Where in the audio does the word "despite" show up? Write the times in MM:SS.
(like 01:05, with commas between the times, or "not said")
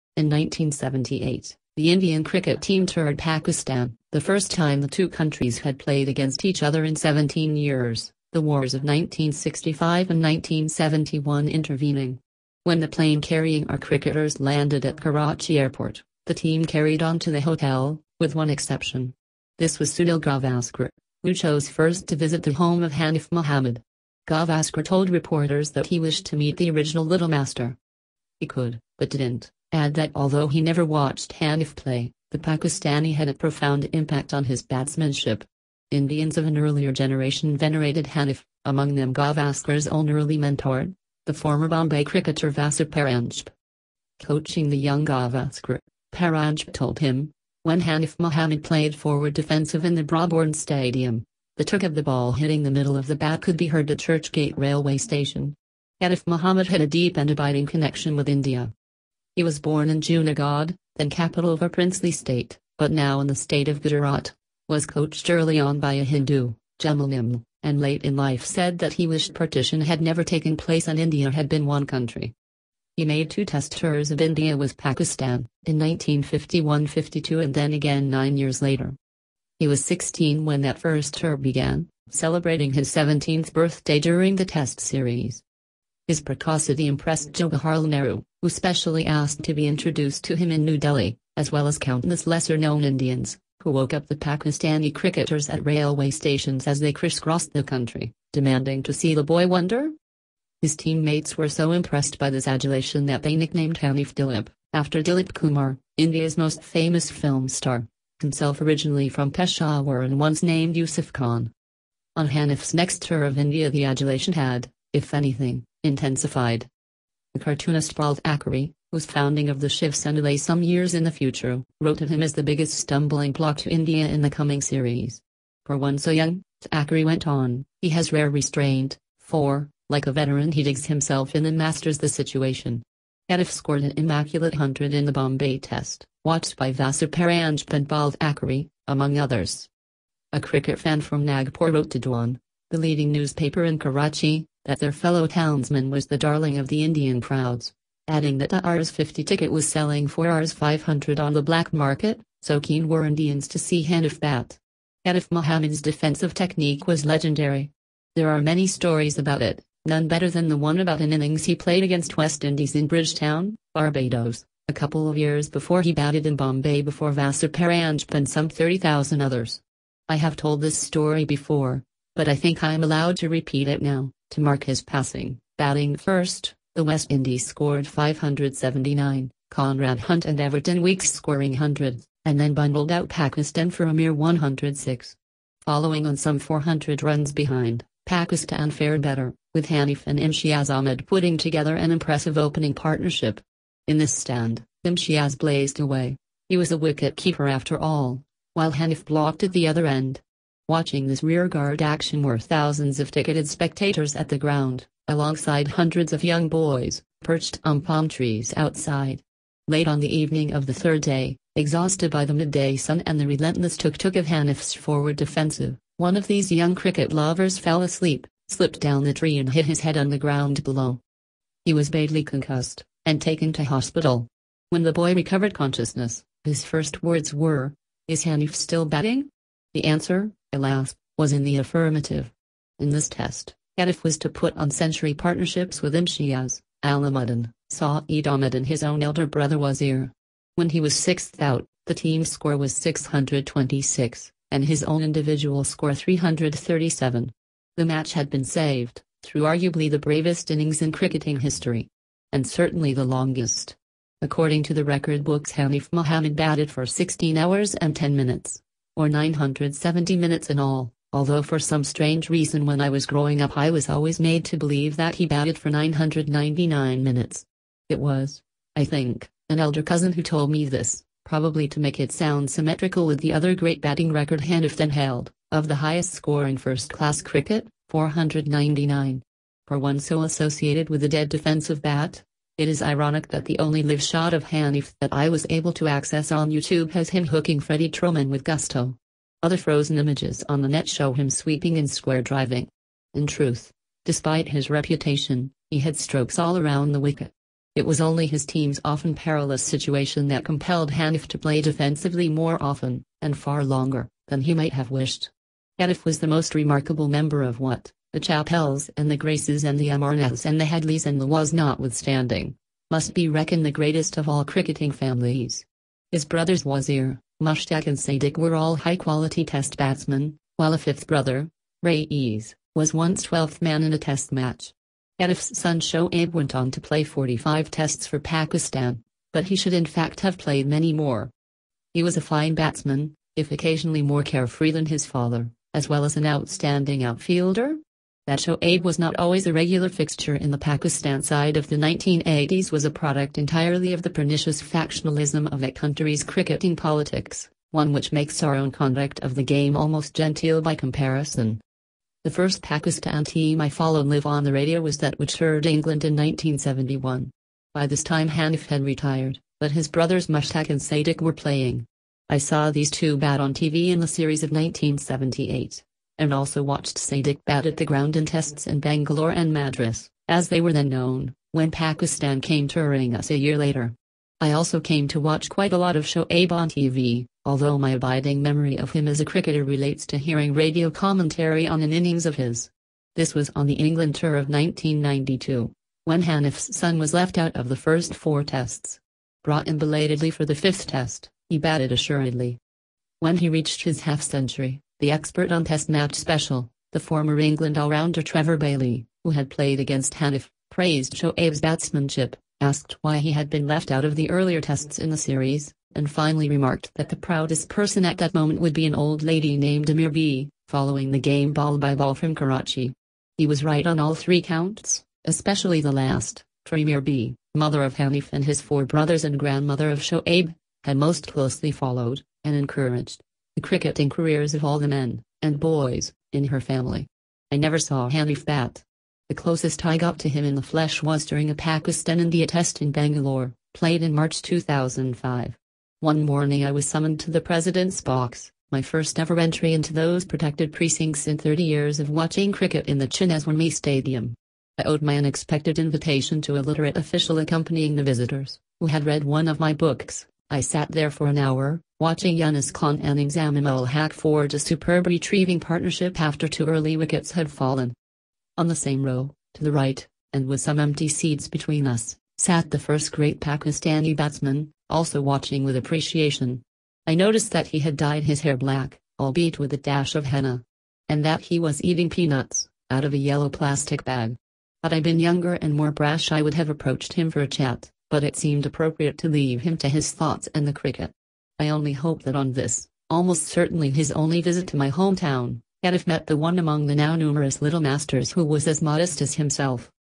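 04:54.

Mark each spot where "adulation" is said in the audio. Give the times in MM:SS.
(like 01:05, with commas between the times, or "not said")
01:42, 01:53.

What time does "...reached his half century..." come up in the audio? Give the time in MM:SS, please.
06:33.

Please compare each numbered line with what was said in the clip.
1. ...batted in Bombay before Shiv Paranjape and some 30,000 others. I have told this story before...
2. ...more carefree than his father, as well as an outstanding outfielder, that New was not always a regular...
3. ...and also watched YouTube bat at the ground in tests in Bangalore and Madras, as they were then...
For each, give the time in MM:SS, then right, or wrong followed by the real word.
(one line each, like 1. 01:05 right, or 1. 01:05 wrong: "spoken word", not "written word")
1. 02:45 wrong: "Vasu", not "Shiv"
2. 05:34 wrong: "Shoaib", not "New"
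3. 06:06 wrong: "Sadiq", not "YouTube".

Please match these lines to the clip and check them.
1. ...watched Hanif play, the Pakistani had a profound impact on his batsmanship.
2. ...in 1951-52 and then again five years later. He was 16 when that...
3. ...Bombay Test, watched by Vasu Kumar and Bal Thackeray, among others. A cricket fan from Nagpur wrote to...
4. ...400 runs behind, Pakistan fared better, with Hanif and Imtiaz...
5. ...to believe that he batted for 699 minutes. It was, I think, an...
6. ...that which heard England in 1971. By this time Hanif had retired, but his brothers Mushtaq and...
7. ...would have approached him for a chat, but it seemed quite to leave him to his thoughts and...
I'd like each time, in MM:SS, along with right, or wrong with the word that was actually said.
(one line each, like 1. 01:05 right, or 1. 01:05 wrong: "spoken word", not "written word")
1. 00:30 right
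2. 01:15 wrong: "nine", not "five"
3. 02:15 wrong: "Paranjape", not "Kumar"
4. 03:06 right
5. 04:24 wrong: "999", not "699"
6. 05:54 right
7. 07:56 wrong: "appropriate", not "quite".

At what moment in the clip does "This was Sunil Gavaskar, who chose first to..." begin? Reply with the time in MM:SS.
00:19.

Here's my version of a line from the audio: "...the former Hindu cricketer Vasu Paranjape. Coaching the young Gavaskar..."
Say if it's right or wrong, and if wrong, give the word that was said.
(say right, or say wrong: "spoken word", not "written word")
wrong: "Bombay", not "Hindu".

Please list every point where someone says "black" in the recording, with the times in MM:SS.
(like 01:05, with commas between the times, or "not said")
02:31, 07:48.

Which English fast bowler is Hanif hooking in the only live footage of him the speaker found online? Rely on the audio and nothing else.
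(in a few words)
Freddie Trueman.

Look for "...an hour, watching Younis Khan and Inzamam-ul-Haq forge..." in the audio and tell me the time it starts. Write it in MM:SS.
07:31.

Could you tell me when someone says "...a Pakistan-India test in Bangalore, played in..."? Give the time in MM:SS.
07:11.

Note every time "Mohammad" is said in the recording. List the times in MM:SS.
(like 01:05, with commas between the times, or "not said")
00:23, 00:48, 00:56, 02:35, 04:15.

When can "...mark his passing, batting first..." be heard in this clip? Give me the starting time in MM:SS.
02:54.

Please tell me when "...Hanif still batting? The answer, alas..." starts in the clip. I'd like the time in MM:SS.
03:48.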